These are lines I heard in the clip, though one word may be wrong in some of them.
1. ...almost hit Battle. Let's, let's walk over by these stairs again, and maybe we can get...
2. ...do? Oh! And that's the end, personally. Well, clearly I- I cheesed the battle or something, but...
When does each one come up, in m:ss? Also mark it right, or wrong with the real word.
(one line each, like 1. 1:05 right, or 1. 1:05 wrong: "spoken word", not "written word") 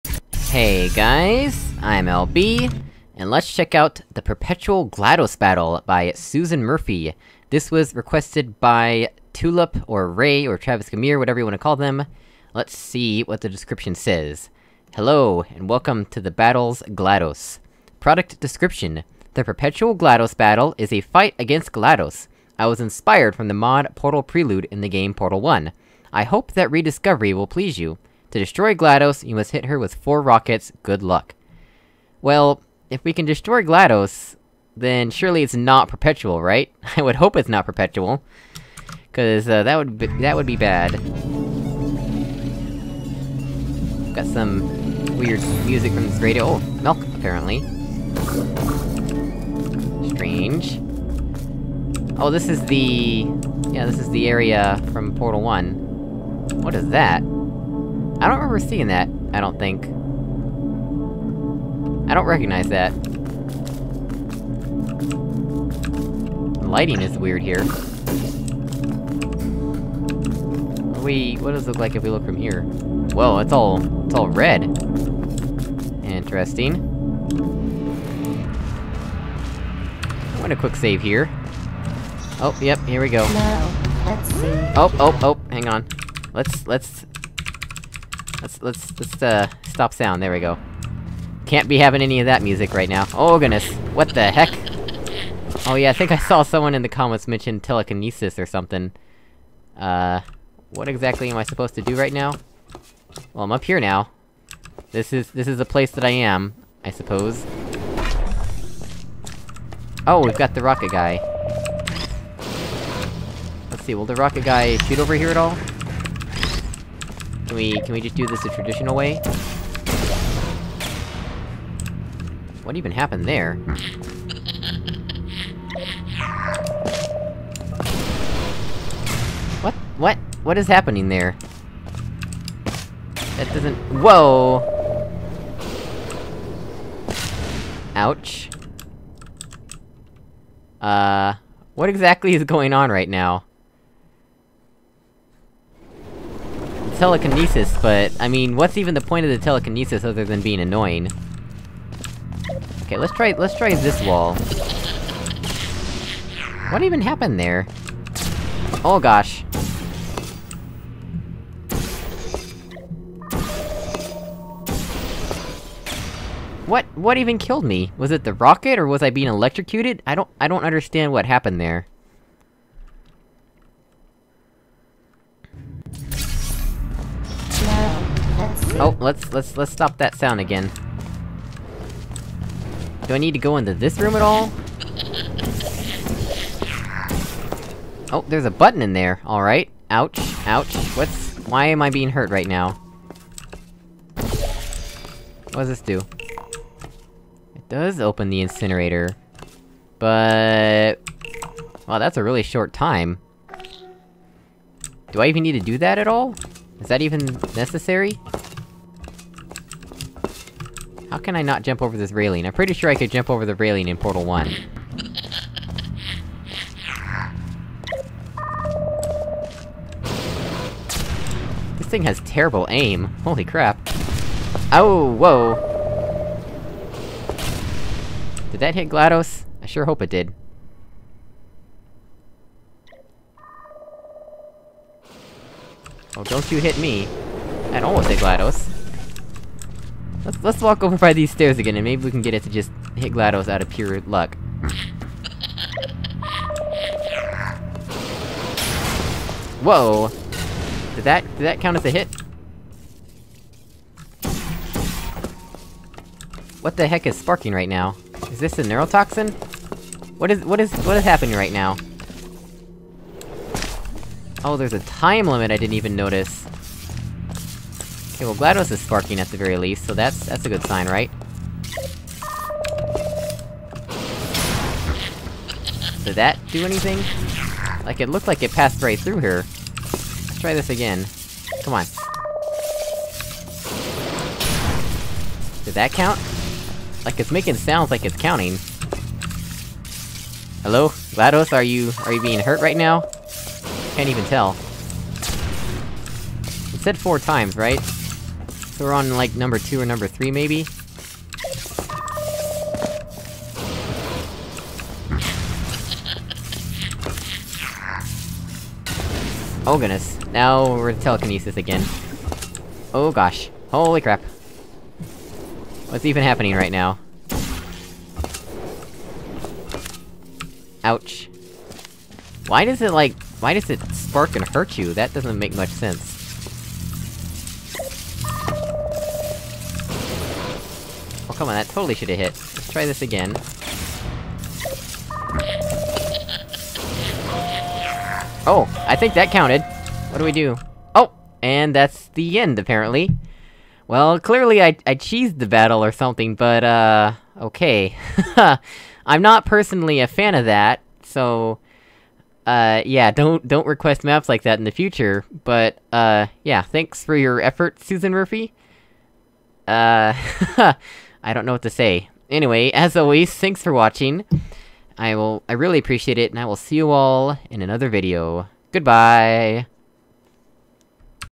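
1. 3:57 wrong: "GLaDOS", not "Battle"
2. 5:40 wrong: "apparently", not "personally".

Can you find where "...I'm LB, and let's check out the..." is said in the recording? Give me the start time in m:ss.
0:01.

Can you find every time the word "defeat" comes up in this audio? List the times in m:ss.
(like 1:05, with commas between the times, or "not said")
not said.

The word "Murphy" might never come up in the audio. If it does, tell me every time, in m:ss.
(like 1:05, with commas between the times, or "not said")
0:06, 5:58.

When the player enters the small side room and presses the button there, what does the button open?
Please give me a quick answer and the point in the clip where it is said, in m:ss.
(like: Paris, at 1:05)
The incinerator, at 3:18.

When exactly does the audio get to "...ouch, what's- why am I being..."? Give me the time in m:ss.
3:10.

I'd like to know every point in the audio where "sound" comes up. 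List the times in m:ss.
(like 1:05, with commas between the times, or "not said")
1:29, 3:00, 4:47.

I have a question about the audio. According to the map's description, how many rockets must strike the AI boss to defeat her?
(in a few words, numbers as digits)
4.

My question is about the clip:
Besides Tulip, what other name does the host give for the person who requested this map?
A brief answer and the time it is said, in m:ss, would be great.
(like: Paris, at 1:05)
Travis Gamir, at 0:10.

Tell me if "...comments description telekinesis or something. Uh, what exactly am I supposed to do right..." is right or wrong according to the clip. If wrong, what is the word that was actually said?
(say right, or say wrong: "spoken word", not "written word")
wrong: "mention", not "description".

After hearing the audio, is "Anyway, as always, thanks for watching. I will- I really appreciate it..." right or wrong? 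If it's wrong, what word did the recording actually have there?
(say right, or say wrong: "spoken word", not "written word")
right.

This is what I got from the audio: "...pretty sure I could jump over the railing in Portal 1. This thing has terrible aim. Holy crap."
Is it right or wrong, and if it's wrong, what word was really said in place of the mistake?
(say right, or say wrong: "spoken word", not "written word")
right.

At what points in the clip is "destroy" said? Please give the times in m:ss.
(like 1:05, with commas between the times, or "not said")
0:28, 0:33.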